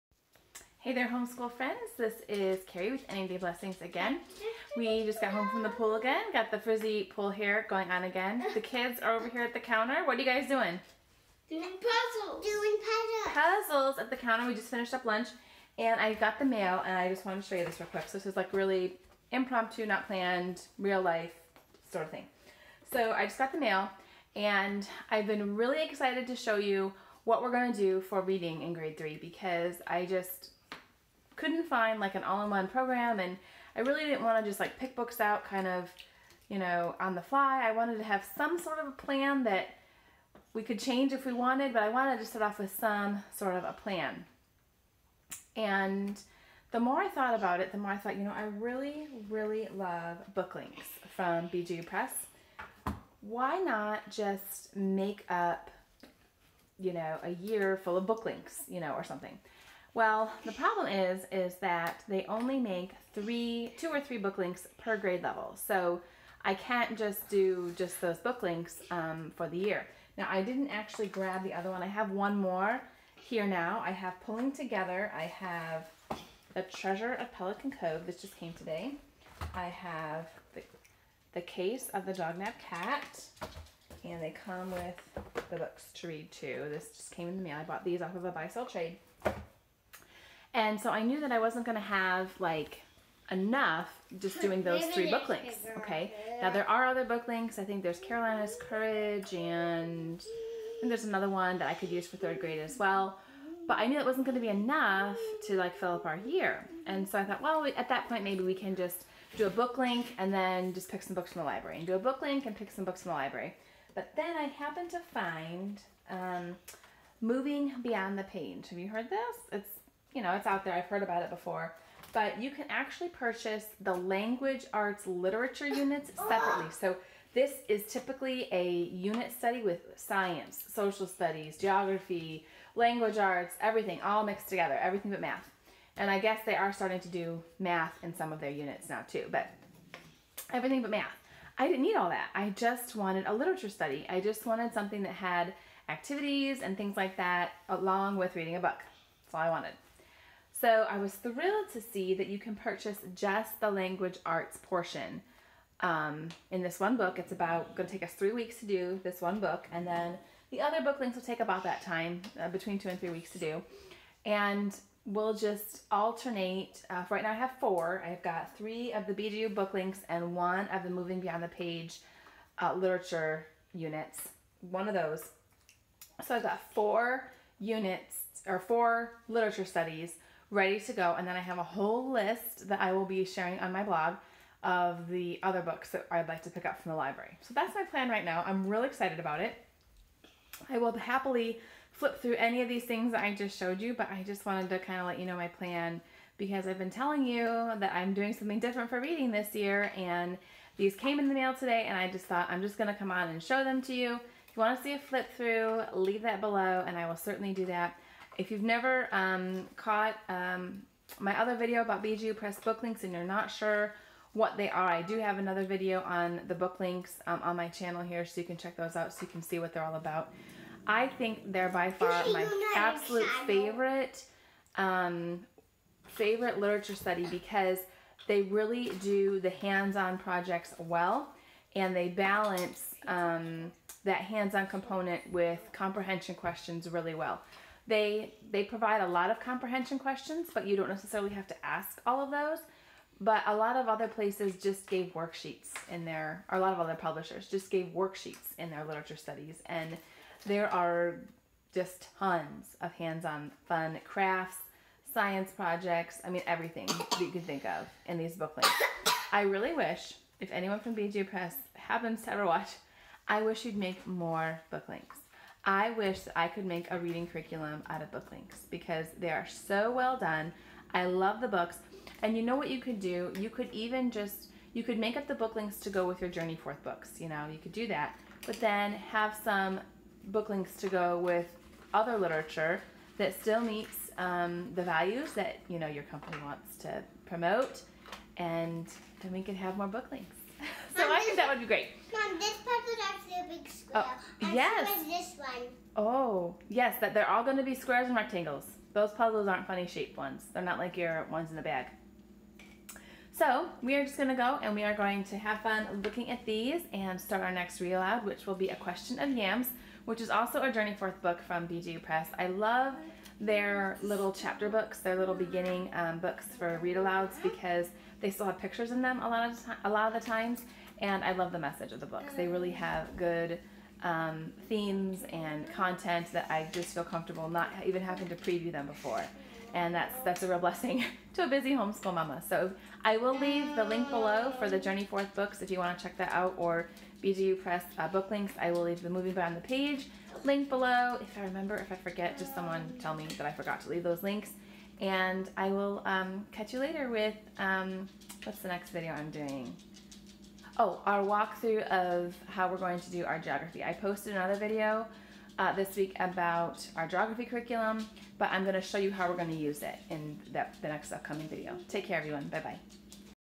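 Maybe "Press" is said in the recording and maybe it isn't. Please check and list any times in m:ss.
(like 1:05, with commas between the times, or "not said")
0:51, 3:32, 4:21, 5:12, 5:37.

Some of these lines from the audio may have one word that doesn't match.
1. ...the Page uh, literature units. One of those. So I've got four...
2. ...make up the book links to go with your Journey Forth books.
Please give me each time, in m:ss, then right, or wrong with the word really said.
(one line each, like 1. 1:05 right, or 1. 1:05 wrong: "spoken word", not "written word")
1. 2:51 right
2. 4:34 right.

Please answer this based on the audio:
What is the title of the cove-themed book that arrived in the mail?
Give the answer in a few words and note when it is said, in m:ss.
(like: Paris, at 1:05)
The Treasure of Pelican Cove, at 1:16.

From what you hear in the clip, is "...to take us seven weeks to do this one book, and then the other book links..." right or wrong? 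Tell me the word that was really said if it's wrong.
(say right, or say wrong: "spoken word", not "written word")
wrong: "three", not "seven".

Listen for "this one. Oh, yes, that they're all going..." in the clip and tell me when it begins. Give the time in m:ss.
4:55.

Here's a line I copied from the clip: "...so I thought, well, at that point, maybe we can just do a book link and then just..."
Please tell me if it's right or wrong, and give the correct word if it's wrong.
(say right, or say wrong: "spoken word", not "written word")
right.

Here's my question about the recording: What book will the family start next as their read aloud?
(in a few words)
A Question of Yams.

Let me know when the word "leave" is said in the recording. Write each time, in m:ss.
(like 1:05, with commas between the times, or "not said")
3:25, 5:33, 5:38, 5:43.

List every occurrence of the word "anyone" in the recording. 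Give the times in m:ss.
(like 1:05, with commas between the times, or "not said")
4:20.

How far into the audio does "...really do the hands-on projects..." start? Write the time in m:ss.
3:48.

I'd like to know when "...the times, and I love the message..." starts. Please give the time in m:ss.
5:20.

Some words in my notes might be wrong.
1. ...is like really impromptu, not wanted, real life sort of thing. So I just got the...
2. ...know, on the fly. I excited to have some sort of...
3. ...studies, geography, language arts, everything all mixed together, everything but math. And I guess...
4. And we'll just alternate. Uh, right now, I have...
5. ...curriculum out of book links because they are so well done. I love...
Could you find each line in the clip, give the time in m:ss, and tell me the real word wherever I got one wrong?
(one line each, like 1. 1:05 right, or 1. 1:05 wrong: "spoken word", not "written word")
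1. 0:18 wrong: "planned", not "wanted"
2. 0:36 wrong: "wanted", not "excited"
3. 2:11 right
4. 2:44 right
5. 4:27 right.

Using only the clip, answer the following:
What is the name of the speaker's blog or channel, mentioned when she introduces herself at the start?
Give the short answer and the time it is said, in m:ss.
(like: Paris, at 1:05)
Any Day Blessings, at 0:03.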